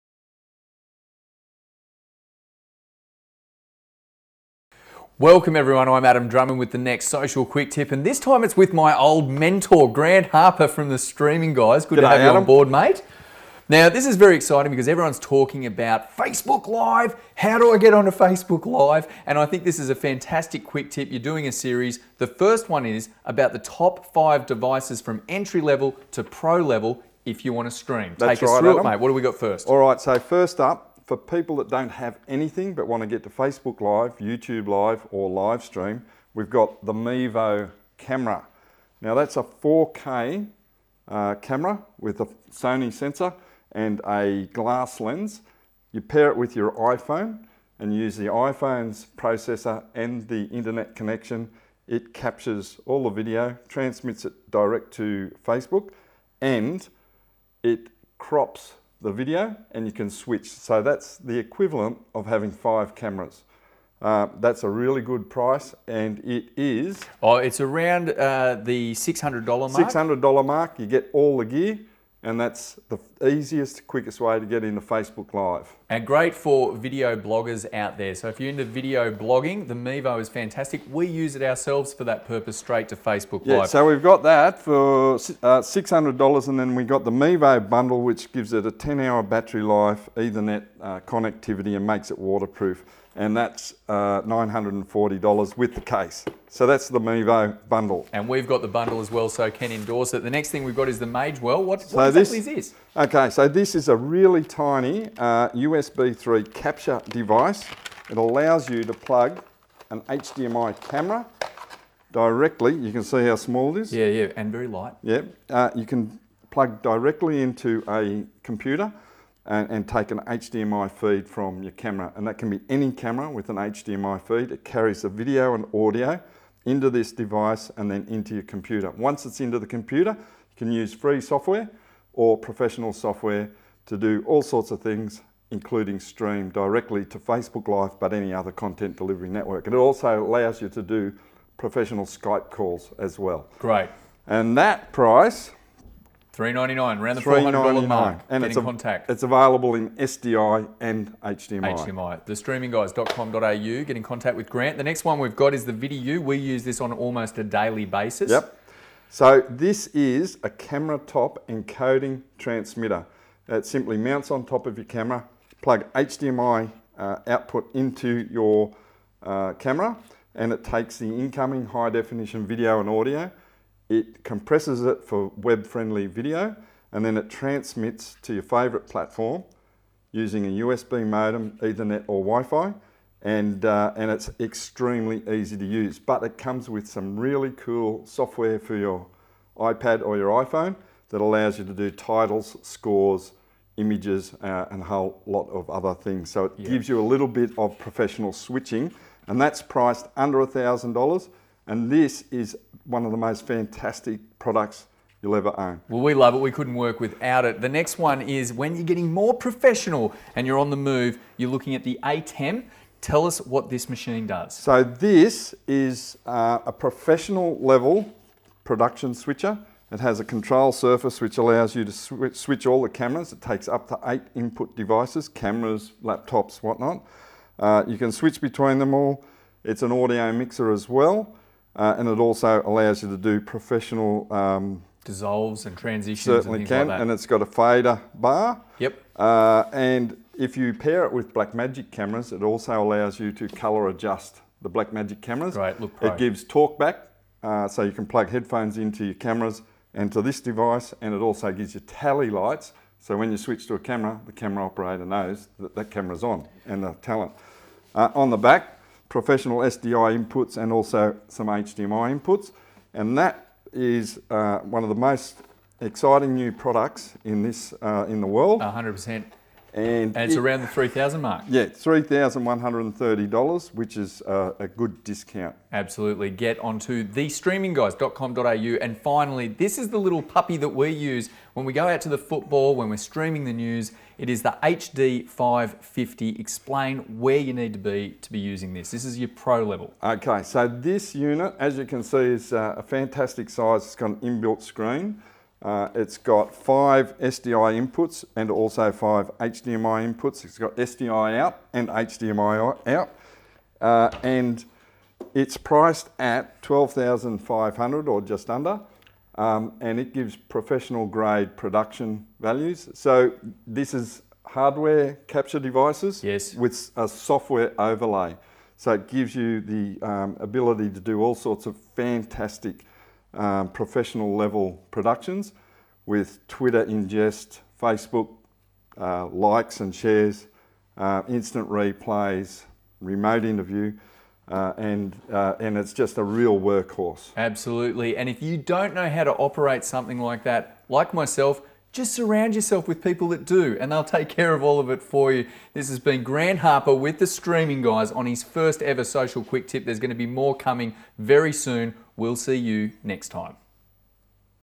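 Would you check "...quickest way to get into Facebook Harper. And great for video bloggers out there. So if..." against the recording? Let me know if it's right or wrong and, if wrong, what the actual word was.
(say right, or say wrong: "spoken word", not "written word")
wrong: "Live", not "Harper".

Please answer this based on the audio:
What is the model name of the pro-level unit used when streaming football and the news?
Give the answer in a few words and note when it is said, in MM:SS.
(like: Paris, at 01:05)
HD 550, at 04:44.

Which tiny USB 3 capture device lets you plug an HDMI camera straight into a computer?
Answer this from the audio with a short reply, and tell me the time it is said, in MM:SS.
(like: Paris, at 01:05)
Magewell, at 01:41.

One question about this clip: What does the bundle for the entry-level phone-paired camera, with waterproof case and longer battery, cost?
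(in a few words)
$940.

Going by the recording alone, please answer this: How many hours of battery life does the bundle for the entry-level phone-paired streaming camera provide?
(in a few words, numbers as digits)
10 hours.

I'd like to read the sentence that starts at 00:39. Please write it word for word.
Now that's a 4K uh, camera with a Sony sensor and a glass lens.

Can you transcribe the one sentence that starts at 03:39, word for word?
It has a control surface which allows you to sw switch all the cameras.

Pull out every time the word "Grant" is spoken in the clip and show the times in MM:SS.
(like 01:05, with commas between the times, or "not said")
00:09, 02:34, 05:46.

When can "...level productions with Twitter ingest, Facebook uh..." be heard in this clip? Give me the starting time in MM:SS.
05:24.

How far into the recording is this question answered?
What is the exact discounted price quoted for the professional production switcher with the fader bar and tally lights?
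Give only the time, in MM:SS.
04:31.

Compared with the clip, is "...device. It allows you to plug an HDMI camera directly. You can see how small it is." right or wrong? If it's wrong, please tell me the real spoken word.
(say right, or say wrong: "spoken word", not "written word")
right.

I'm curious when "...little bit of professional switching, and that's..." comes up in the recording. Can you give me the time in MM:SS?
03:17.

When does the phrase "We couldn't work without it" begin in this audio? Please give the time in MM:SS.
03:26.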